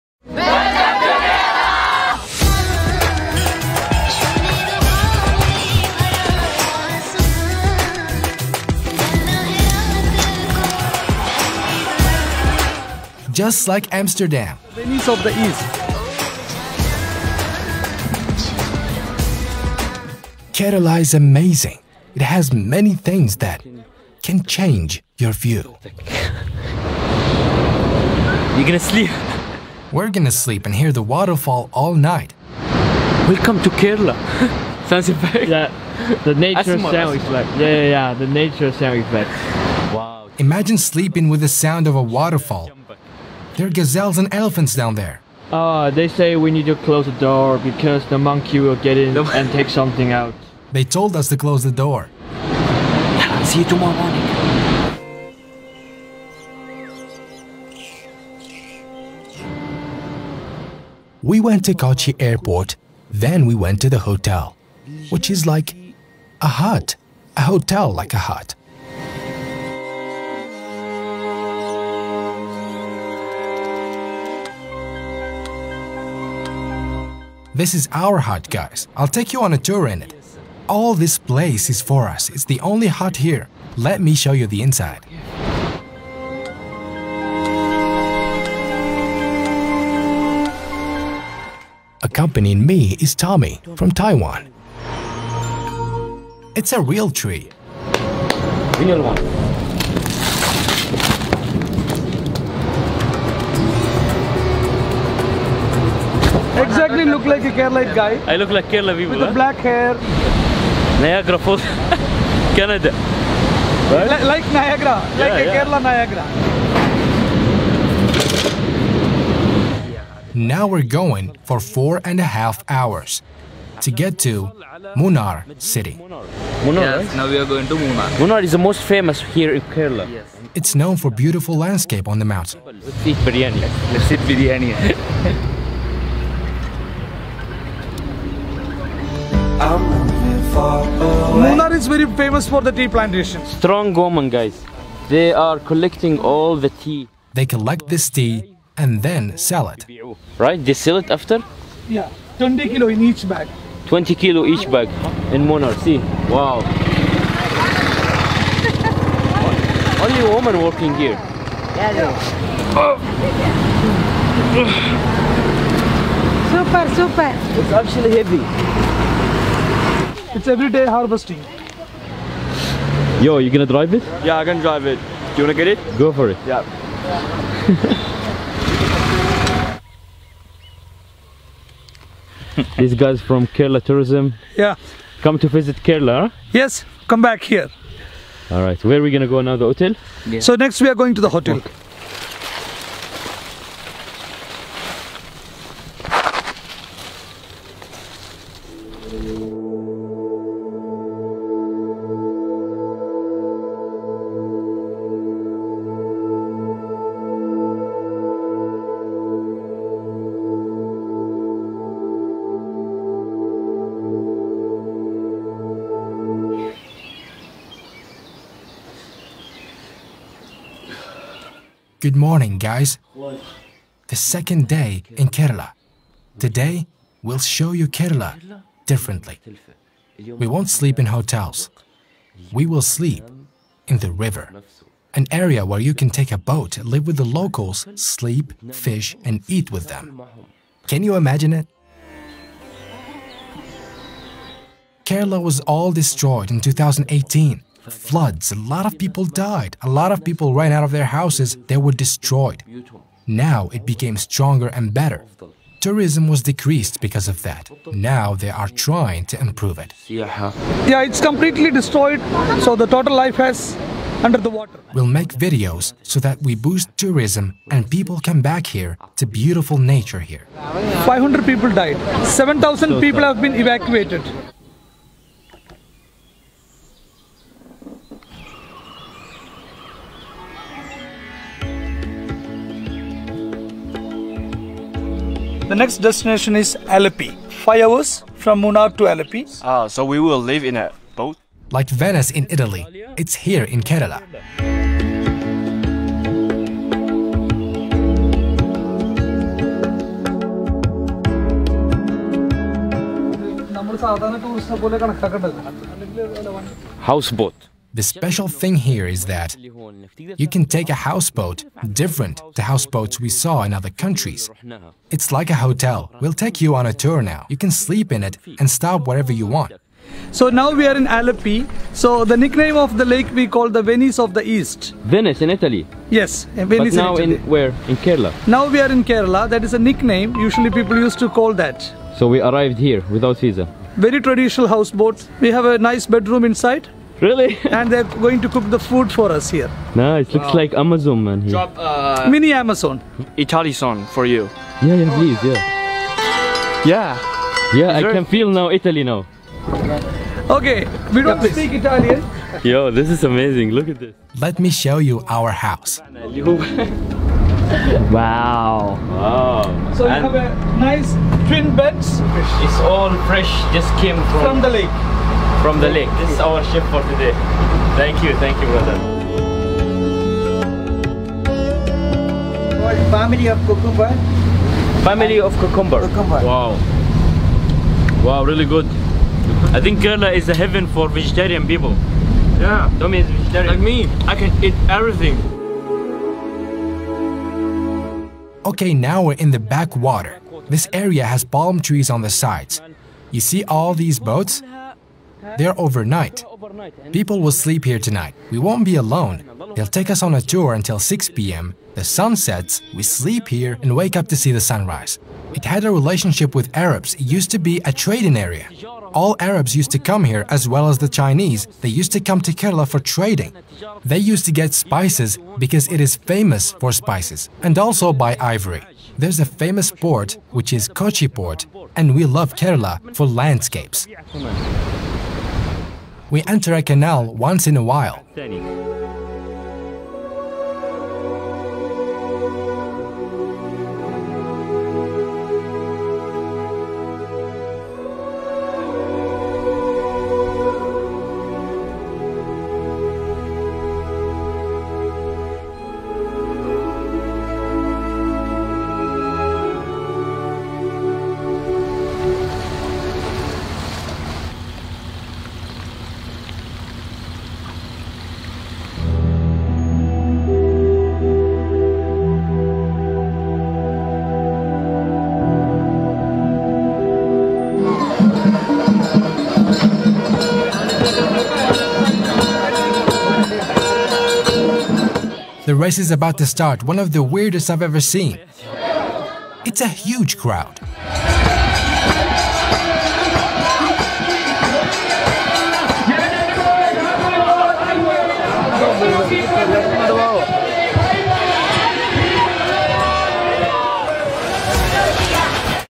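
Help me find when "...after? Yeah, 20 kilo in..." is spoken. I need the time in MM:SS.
02:31.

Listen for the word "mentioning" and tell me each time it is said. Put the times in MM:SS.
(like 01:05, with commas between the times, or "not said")
not said.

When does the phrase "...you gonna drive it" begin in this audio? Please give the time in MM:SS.
02:53.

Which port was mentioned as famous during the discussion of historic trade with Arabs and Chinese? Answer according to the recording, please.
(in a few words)
Kochi port.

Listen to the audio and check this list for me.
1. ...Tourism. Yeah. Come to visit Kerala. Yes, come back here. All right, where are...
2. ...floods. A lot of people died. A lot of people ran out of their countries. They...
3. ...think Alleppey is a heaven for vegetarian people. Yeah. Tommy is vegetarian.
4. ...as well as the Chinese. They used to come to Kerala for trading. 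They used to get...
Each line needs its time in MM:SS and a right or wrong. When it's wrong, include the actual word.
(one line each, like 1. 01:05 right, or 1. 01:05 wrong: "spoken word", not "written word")
1. 03:03 right
2. 04:07 wrong: "houses", not "countries"
3. 06:19 wrong: "Kerala", not "Alleppey"
4. 06:50 right.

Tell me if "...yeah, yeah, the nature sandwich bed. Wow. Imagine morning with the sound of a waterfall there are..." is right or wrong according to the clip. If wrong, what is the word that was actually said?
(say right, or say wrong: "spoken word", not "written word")
wrong: "sleeping", not "morning".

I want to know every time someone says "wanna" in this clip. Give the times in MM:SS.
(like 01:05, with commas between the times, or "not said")
02:55.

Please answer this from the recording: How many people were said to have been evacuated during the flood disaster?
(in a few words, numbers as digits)
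7,000.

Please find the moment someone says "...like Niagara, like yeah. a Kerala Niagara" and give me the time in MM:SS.
01:54.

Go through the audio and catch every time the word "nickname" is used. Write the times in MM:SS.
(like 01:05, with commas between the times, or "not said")
05:22, 05:29.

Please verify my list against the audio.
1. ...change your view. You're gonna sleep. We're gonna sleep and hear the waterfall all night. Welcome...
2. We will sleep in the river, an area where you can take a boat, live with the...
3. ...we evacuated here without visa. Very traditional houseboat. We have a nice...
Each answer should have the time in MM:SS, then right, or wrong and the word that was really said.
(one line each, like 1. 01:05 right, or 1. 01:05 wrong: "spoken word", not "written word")
1. 00:24 right
2. 03:52 right
3. 05:32 wrong: "arrived", not "evacuated".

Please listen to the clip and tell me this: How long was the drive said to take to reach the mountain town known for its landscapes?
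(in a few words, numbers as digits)
4.5 hours.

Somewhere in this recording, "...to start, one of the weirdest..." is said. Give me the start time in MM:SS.
07:56.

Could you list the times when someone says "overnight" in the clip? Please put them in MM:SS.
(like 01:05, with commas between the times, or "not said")
06:35.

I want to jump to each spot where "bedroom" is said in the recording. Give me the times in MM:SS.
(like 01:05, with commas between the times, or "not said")
05:36.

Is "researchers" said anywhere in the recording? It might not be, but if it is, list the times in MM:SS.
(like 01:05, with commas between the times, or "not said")
not said.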